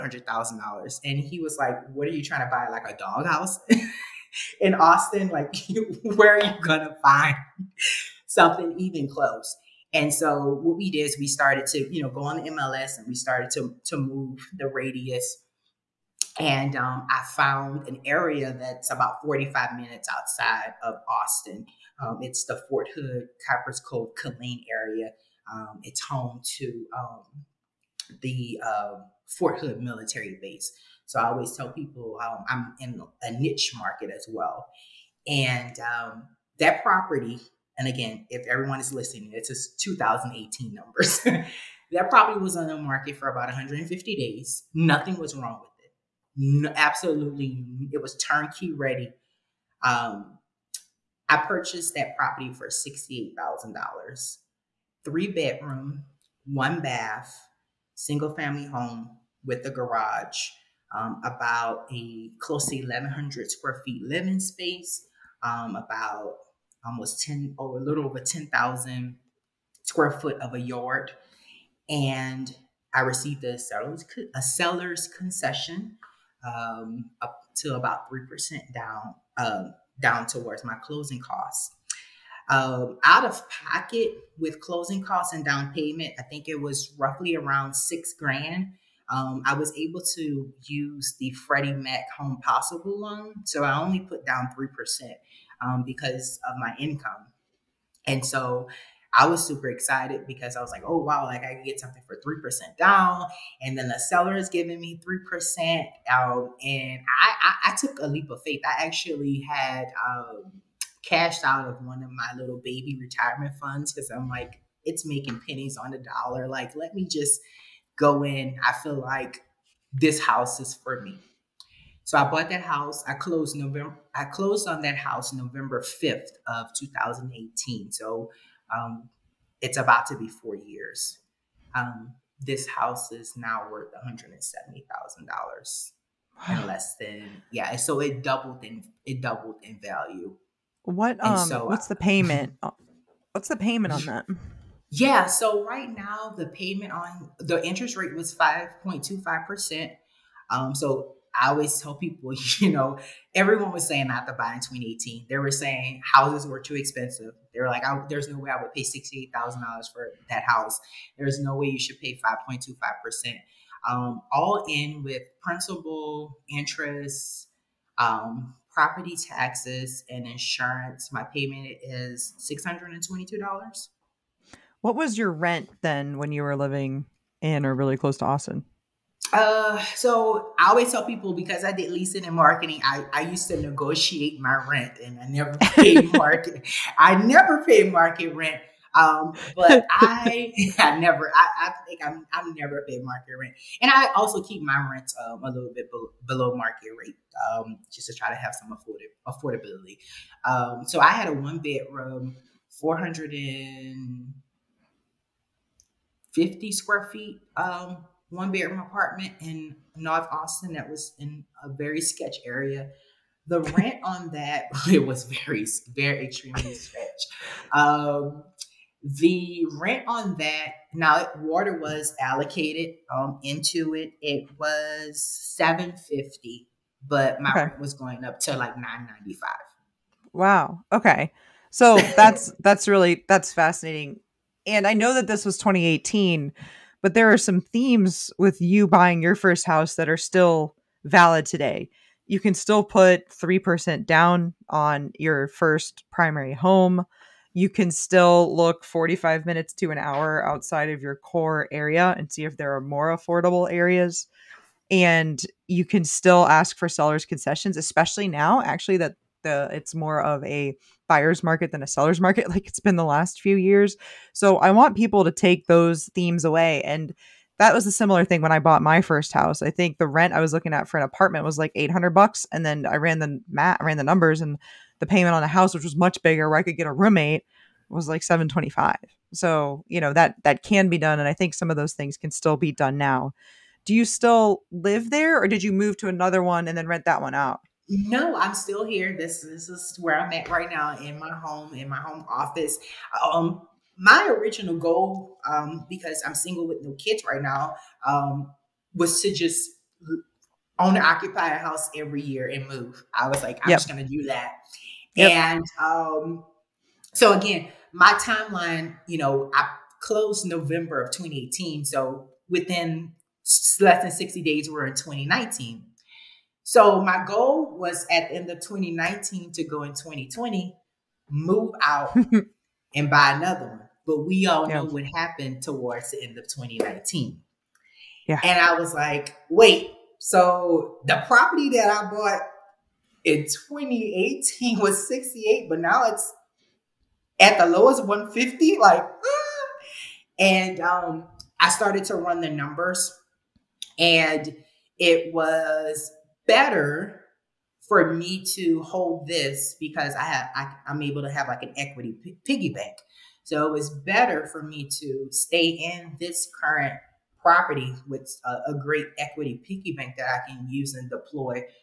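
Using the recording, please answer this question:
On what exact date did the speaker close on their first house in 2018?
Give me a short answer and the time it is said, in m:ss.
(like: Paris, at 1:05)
November 5th, at 2:05.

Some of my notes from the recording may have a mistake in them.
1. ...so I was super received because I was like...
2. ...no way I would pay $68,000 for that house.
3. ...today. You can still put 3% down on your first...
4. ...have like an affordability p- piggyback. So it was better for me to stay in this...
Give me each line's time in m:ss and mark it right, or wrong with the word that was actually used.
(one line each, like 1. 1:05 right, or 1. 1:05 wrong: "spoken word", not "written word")
1. 1:38 wrong: "excited", not "received"
2. 2:38 right
3. 4:01 right
4. 5:51 wrong: "equity", not "affordability".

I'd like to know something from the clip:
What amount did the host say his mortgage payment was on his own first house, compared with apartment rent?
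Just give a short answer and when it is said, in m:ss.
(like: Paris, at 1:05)
$725, at 4:38.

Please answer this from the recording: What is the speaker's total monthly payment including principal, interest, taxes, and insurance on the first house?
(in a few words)
$622.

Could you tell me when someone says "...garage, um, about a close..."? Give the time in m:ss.
0:59.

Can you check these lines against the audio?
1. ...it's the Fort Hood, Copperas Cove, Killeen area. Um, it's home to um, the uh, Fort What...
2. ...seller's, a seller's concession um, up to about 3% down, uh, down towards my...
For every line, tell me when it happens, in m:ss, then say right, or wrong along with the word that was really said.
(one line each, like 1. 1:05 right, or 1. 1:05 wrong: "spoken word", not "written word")
1. 0:22 wrong: "Hood", not "What"
2. 1:13 right.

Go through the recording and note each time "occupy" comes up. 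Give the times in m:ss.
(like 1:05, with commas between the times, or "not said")
5:01.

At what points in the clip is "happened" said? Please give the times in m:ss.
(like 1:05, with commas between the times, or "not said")
5:25.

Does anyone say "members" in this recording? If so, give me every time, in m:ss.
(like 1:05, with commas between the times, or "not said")
not said.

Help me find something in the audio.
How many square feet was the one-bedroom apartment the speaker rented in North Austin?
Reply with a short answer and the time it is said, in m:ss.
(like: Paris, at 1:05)
450, at 3:22.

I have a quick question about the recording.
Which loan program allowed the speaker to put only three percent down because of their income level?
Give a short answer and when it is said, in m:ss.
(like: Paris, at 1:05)
Freddie Mac Home Possible, at 1:31.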